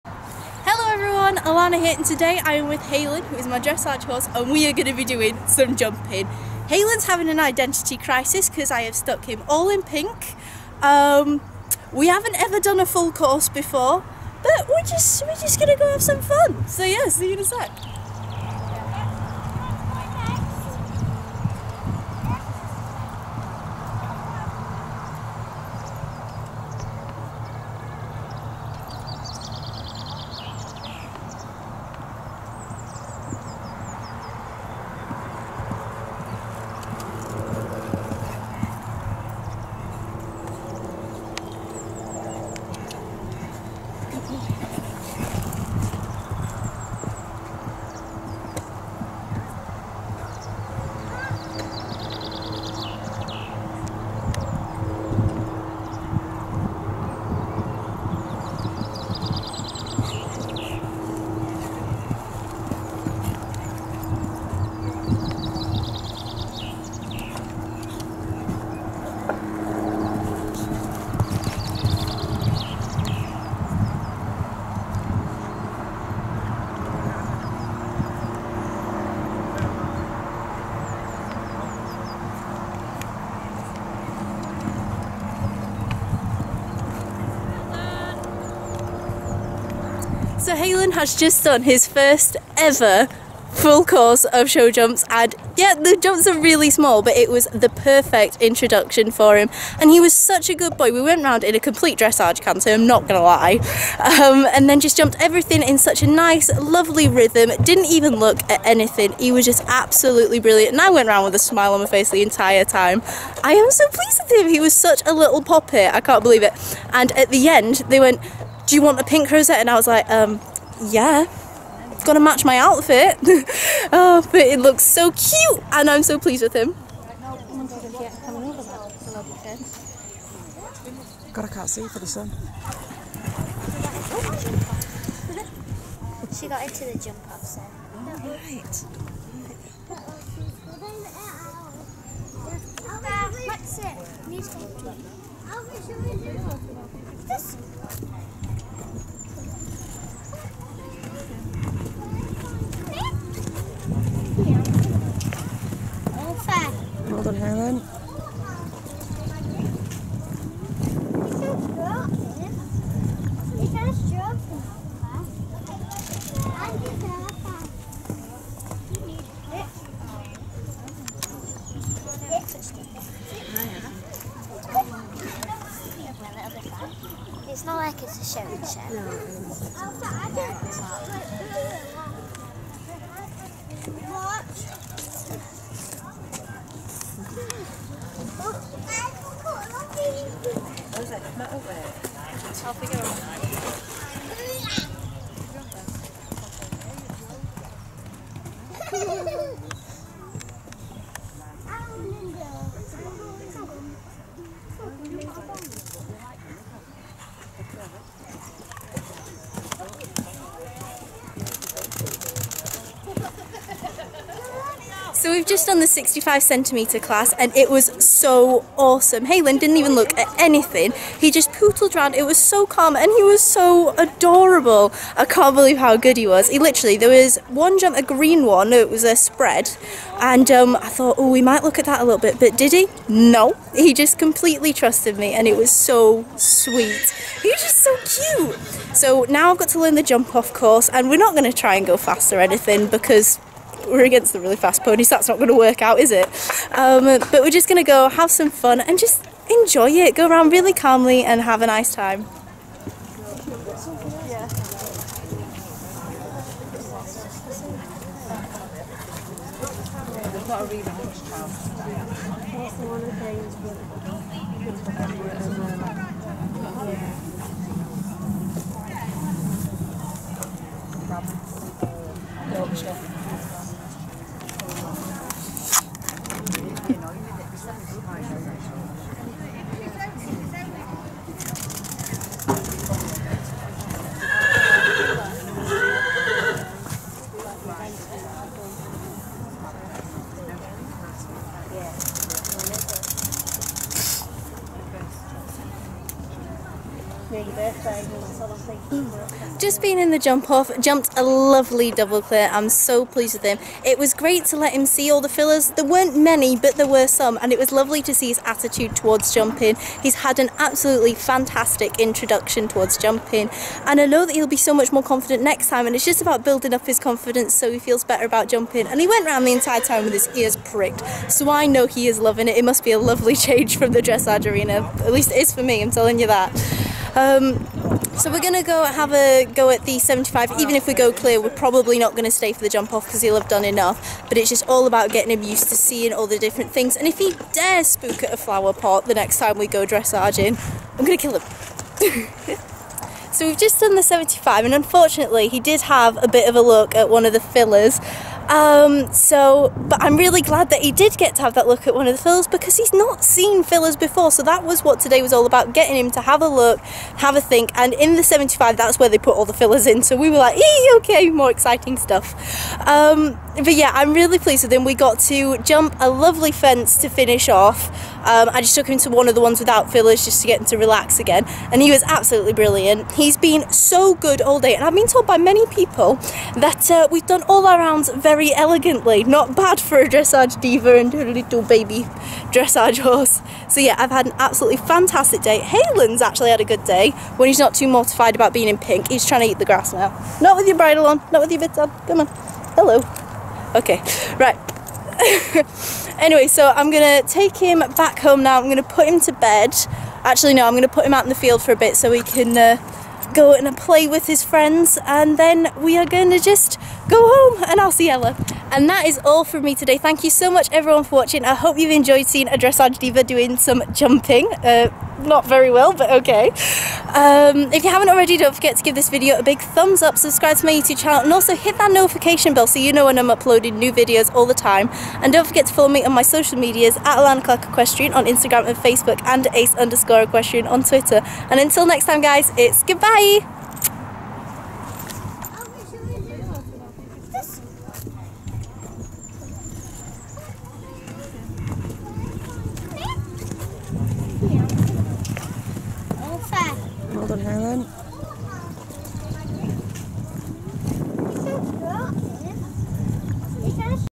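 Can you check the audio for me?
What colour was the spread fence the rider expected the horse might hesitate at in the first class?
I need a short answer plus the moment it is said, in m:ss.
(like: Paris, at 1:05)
Green, at 3:48.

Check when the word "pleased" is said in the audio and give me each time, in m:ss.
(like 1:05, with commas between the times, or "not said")
1:53, 2:06, 5:03, 6:04.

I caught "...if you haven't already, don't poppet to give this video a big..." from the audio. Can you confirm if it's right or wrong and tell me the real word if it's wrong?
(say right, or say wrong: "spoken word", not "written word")
wrong: "forget", not "poppet".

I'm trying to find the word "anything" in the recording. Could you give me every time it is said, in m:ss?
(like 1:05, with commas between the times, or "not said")
1:48, 3:40, 4:02.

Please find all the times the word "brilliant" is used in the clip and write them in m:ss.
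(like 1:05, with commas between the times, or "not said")
1:50, 6:12.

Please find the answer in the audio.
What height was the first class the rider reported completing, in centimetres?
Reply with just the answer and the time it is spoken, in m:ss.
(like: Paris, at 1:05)
65 centimetres, at 3:35.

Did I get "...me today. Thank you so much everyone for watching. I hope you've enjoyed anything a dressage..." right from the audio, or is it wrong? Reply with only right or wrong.
wrong.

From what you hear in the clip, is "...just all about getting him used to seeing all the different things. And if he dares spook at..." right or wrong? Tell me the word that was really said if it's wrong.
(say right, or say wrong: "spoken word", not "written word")
right.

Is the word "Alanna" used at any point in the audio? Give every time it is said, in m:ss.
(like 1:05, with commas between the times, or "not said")
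0:01, 7:07.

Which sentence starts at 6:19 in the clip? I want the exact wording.
Not bad for a dressage diva and a little baby dressage horse.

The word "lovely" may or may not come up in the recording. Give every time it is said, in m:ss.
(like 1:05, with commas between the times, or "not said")
1:46, 5:01, 5:07, 5:22, 6:06.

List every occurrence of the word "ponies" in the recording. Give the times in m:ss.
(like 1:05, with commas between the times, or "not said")
4:04.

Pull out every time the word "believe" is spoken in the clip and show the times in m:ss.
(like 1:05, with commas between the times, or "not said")
1:56, 3:45.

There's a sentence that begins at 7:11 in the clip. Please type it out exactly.
And until next time, guys, it's goodbye!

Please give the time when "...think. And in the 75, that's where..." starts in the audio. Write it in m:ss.
5:57.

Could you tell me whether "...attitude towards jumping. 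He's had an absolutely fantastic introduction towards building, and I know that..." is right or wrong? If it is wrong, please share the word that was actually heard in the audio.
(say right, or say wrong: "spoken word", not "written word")
wrong: "jumping", not "building".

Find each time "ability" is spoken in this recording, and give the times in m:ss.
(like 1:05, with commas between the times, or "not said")
not said.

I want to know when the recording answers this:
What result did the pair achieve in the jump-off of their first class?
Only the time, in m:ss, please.
5:01.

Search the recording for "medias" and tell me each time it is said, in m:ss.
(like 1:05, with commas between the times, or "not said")
7:06.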